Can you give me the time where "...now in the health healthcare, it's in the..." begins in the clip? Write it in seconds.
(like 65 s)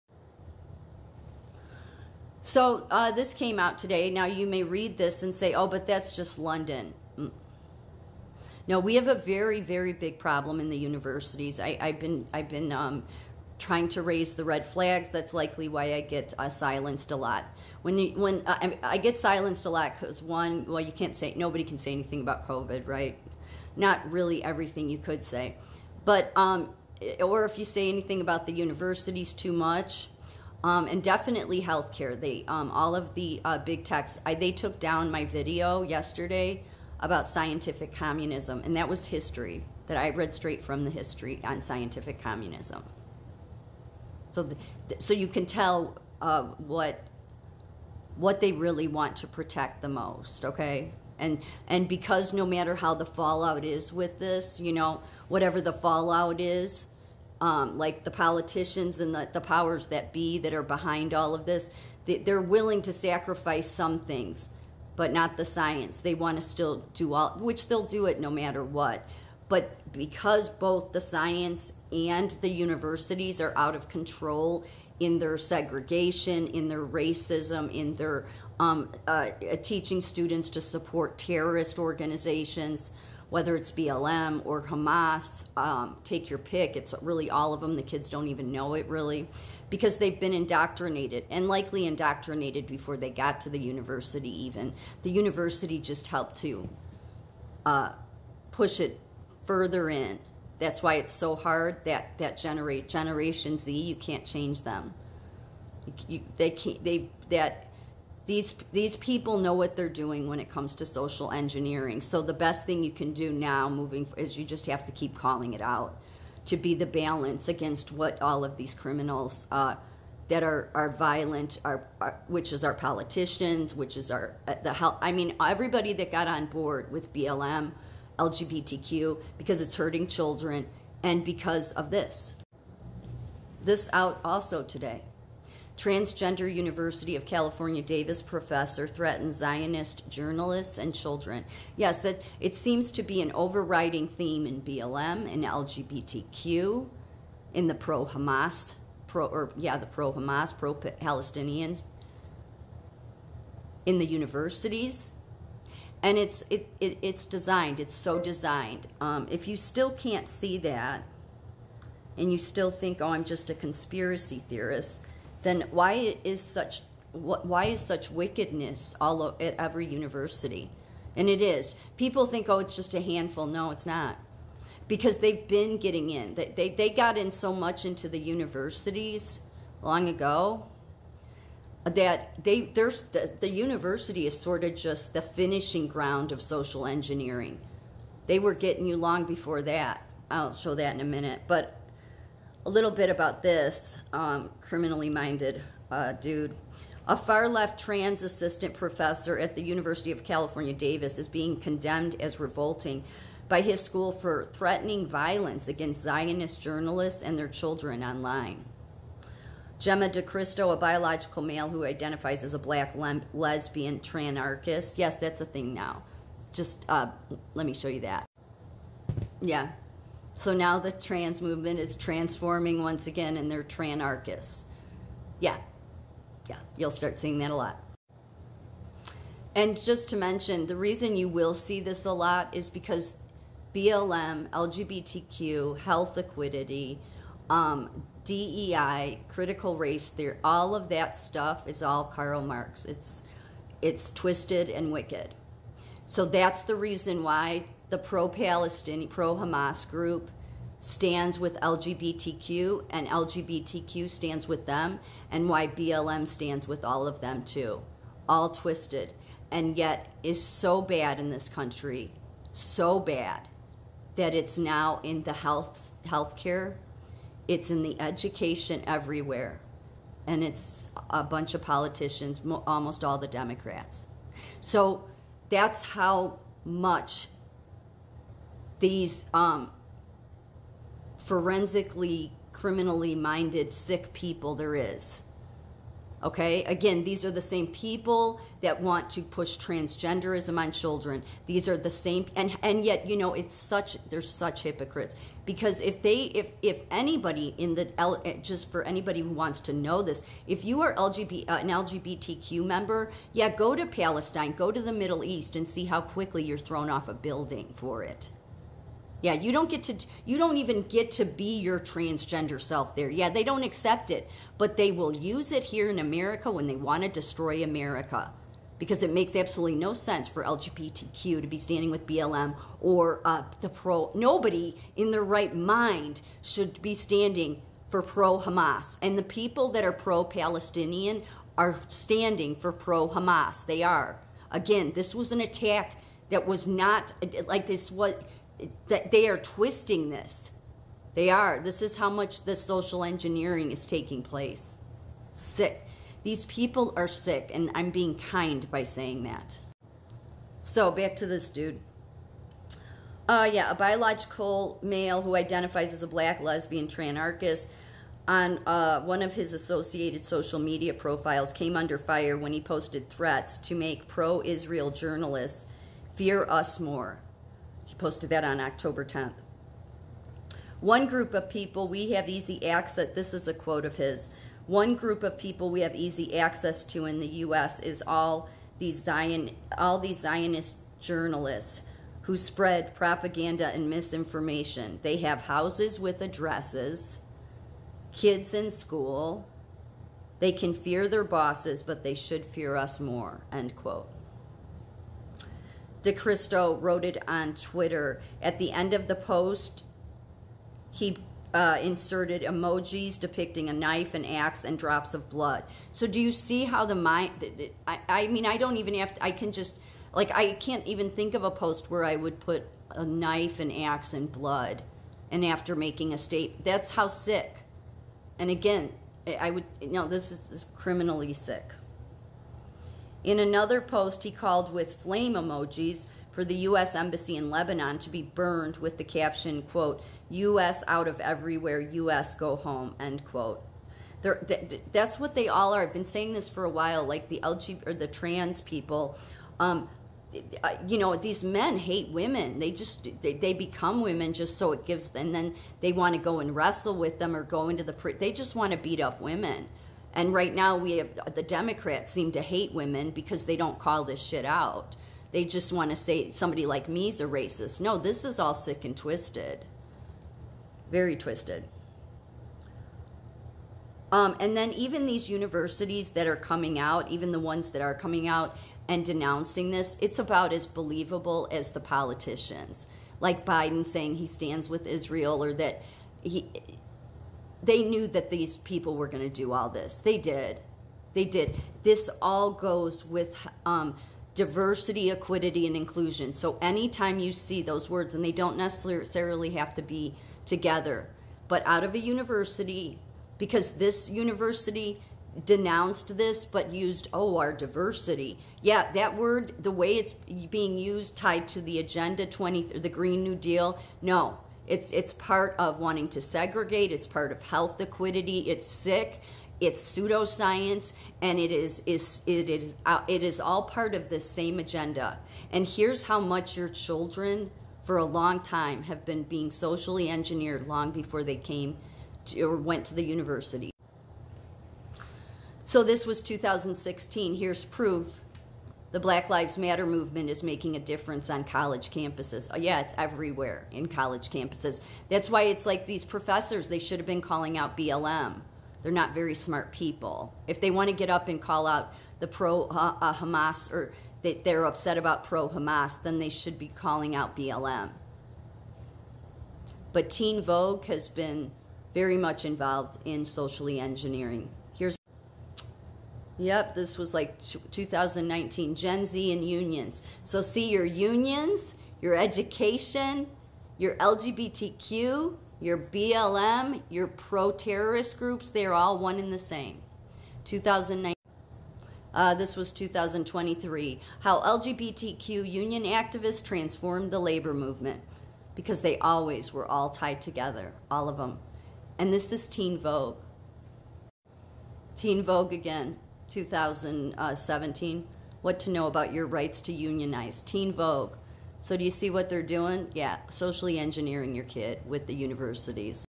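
264 s.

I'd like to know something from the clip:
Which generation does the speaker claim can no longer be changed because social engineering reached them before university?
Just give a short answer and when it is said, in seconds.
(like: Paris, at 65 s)
Generation Z, at 102 s.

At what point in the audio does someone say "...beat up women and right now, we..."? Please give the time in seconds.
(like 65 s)
448 s.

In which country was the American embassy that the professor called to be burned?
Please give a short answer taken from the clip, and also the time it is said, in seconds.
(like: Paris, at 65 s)
Lebanon, at 427 s.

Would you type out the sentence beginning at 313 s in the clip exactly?
Yeah, they don't accept it, but they will use it here in America when they want to destroy America.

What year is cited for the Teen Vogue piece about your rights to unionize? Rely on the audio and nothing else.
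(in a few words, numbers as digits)
2017.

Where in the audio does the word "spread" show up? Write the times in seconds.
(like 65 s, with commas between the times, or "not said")
382 s.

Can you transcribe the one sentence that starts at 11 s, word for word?
I, have been, I've been um, trying to raise the red flags.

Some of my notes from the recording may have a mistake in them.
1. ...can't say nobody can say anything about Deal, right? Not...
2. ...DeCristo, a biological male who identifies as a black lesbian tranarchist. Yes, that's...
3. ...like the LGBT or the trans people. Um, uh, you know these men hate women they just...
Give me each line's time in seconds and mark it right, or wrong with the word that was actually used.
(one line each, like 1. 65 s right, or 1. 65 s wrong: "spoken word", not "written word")
1. 20 s wrong: "COVID", not "Deal"
2. 210 s right
3. 437 s right.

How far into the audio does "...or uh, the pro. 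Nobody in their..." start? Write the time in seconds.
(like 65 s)
322 s.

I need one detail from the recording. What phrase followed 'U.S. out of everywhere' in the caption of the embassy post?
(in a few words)
U.S. go home.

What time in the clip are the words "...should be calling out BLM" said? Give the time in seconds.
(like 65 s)
546 s.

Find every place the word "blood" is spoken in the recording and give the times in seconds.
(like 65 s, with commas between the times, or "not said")
405 s, 414 s.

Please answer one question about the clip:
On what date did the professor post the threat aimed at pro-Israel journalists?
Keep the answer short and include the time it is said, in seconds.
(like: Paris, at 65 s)
October 10th, at 368 s.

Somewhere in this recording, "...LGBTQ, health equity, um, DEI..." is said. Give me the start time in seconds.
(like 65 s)
234 s.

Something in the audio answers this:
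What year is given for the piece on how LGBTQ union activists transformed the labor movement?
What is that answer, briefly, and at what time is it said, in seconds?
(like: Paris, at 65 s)
2023, at 572 s.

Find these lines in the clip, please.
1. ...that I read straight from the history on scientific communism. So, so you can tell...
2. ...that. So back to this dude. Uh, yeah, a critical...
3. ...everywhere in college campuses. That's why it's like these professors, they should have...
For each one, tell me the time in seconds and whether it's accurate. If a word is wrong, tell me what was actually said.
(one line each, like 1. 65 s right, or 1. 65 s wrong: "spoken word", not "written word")
1. 39 s right
2. 349 s wrong: "biological", not "critical"
3. 532 s right.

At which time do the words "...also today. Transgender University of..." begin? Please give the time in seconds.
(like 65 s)
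134 s.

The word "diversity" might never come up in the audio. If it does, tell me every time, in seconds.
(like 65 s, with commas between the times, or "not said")
484 s, 497 s.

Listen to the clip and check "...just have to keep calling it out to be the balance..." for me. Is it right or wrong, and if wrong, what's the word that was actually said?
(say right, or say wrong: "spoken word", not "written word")
right.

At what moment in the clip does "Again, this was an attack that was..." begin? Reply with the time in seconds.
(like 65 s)
334 s.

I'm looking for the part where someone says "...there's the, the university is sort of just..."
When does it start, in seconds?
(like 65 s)
182 s.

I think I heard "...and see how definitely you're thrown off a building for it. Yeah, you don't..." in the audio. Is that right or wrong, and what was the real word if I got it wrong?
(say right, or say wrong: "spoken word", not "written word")
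wrong: "quickly", not "definitely".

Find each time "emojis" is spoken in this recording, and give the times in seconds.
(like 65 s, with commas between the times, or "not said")
402 s, 425 s.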